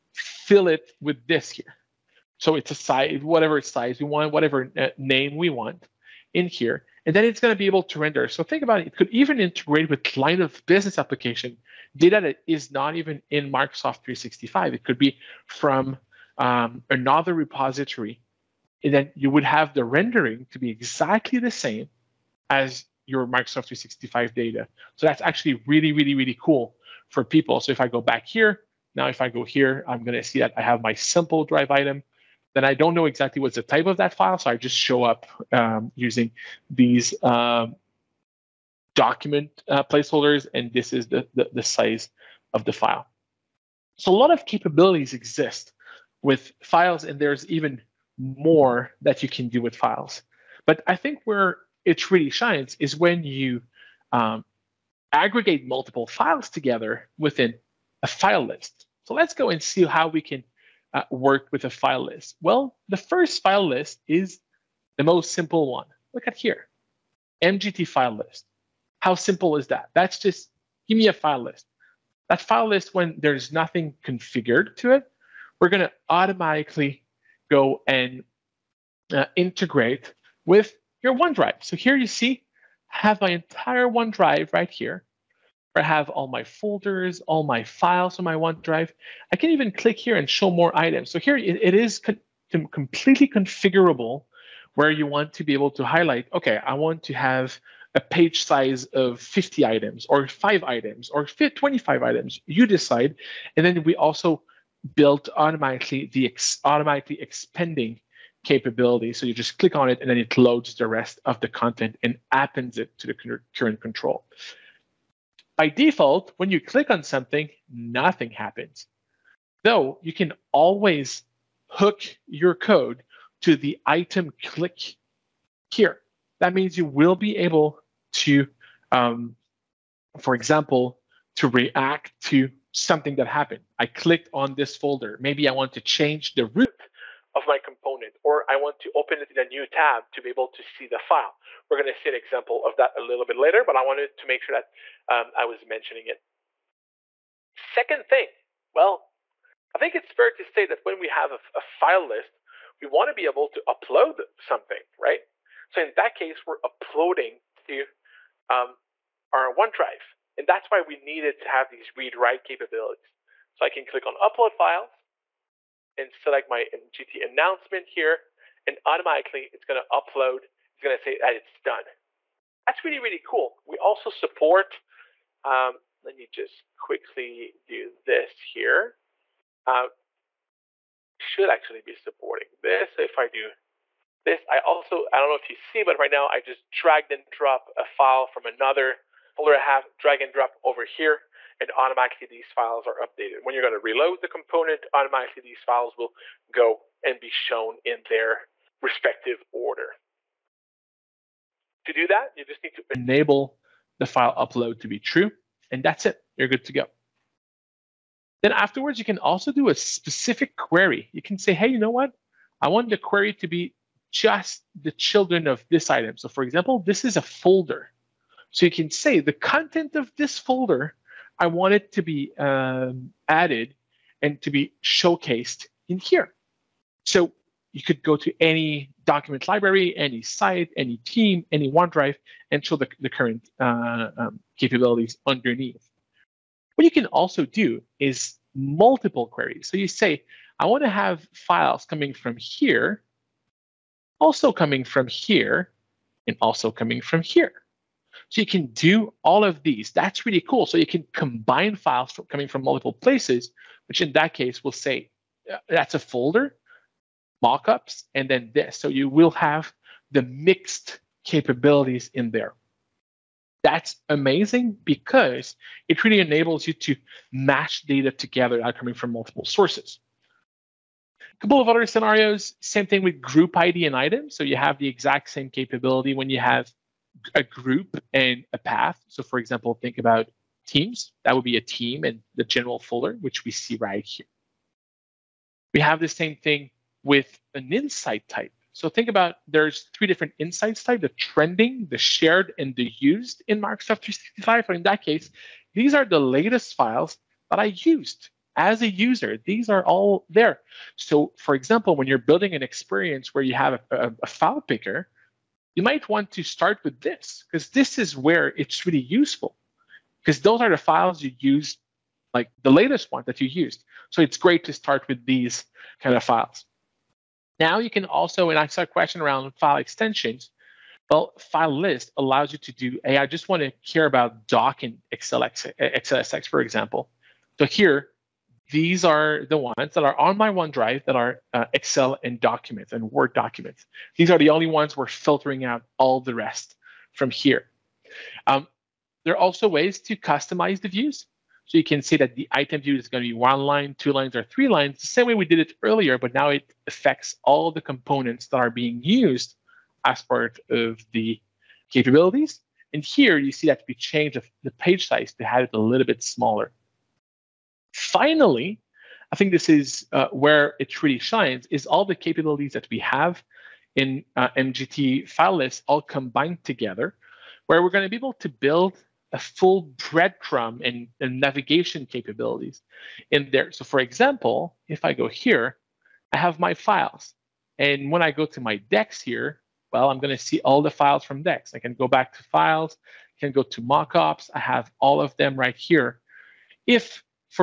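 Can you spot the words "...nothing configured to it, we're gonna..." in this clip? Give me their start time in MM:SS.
01:13.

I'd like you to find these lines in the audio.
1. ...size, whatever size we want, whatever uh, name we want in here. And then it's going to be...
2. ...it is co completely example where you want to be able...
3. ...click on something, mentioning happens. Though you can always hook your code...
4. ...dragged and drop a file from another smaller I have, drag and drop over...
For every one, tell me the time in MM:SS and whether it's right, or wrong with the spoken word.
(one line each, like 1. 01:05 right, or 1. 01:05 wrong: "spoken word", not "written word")
1. 00:02 right
2. 01:31 wrong: "configurable", not "example"
3. 01:56 wrong: "nothing", not "mentioning"
4. 03:06 wrong: "folder", not "smaller".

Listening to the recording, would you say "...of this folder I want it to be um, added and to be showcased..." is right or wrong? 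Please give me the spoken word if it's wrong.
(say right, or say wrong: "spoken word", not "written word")
right.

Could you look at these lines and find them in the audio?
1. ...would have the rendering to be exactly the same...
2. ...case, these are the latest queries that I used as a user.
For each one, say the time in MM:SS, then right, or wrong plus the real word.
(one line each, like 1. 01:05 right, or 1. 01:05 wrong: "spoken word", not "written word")
1. 00:19 right
2. 04:55 wrong: "files", not "queries".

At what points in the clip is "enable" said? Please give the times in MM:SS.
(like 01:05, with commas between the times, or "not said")
03:22, 04:26.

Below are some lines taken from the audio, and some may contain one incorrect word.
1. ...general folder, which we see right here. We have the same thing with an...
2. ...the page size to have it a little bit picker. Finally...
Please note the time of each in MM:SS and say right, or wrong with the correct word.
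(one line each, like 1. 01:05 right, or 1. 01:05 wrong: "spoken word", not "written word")
1. 04:42 right
2. 05:54 wrong: "smaller", not "picker".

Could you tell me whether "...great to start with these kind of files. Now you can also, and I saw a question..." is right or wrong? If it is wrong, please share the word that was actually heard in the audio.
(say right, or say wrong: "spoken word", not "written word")
right.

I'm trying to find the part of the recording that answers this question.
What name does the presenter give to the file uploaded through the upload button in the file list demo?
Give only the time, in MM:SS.
02:46.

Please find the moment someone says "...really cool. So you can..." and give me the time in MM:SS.
04:10.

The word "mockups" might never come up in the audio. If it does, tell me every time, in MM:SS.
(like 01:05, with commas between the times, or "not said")
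04:17, 06:23.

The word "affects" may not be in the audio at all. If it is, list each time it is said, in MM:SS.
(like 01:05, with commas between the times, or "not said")
05:46.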